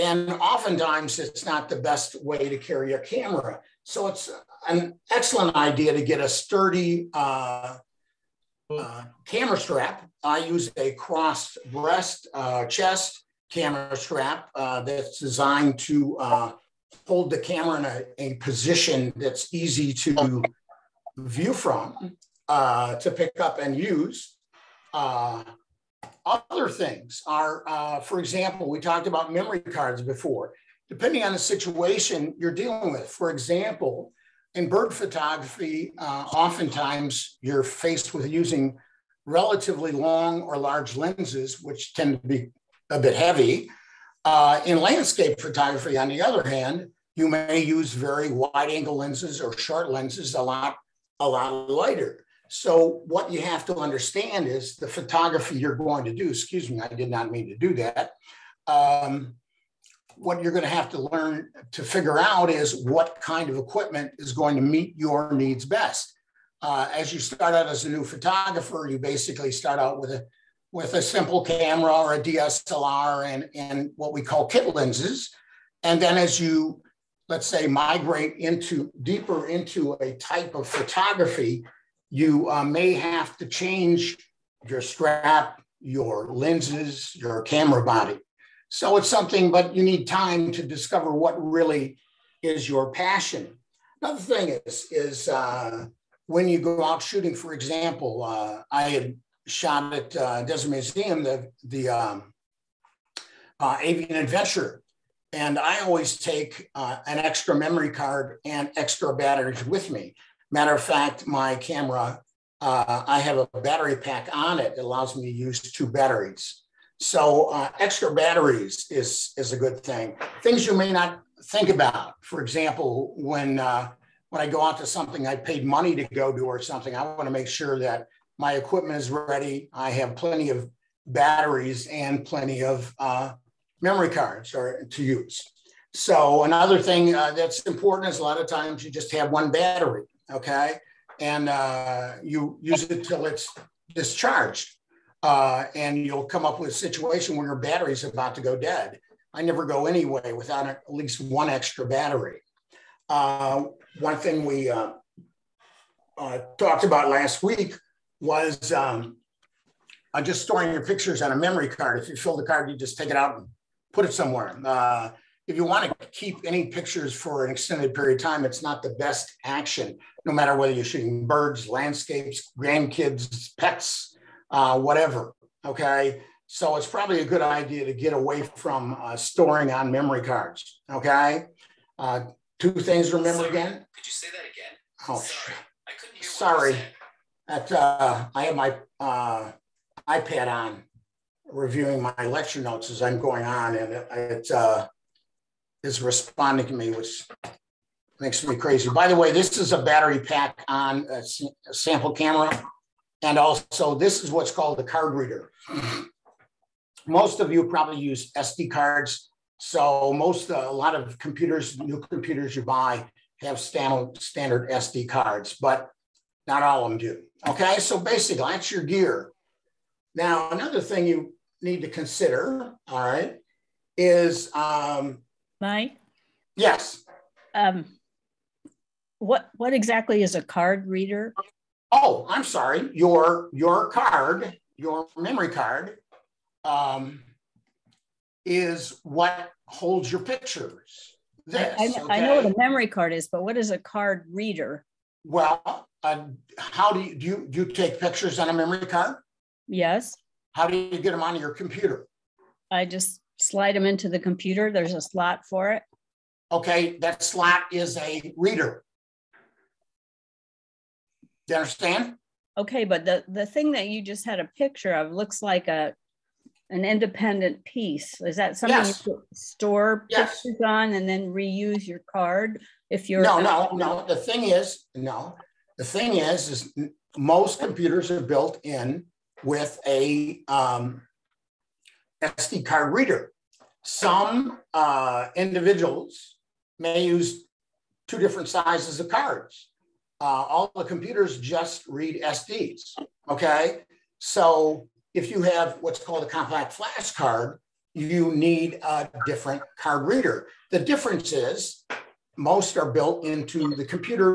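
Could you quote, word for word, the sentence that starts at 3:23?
And also, this is what's called the card reader.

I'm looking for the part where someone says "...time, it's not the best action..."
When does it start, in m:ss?
2:48.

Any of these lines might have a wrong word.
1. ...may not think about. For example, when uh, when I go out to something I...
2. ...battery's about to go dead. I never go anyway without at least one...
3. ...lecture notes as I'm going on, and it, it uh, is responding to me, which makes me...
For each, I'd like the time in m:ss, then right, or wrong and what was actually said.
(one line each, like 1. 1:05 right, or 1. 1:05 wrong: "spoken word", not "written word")
1. 2:00 right
2. 2:27 right
3. 3:12 right.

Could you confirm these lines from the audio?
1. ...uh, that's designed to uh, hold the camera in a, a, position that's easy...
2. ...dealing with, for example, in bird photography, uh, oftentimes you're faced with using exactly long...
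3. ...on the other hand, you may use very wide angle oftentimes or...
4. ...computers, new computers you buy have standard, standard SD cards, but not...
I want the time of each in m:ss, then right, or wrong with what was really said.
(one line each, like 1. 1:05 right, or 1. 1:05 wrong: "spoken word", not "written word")
1. 0:14 right
2. 0:32 wrong: "relatively", not "exactly"
3. 0:45 wrong: "lenses", not "oftentimes"
4. 3:31 right.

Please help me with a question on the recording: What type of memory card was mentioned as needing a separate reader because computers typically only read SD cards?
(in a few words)
compact flash card.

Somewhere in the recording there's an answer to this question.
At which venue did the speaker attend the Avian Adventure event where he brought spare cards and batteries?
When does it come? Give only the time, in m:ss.
1:40.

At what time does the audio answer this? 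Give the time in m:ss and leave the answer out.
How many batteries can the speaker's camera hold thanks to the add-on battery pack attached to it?
1:55.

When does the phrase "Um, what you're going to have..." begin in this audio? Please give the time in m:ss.
0:58.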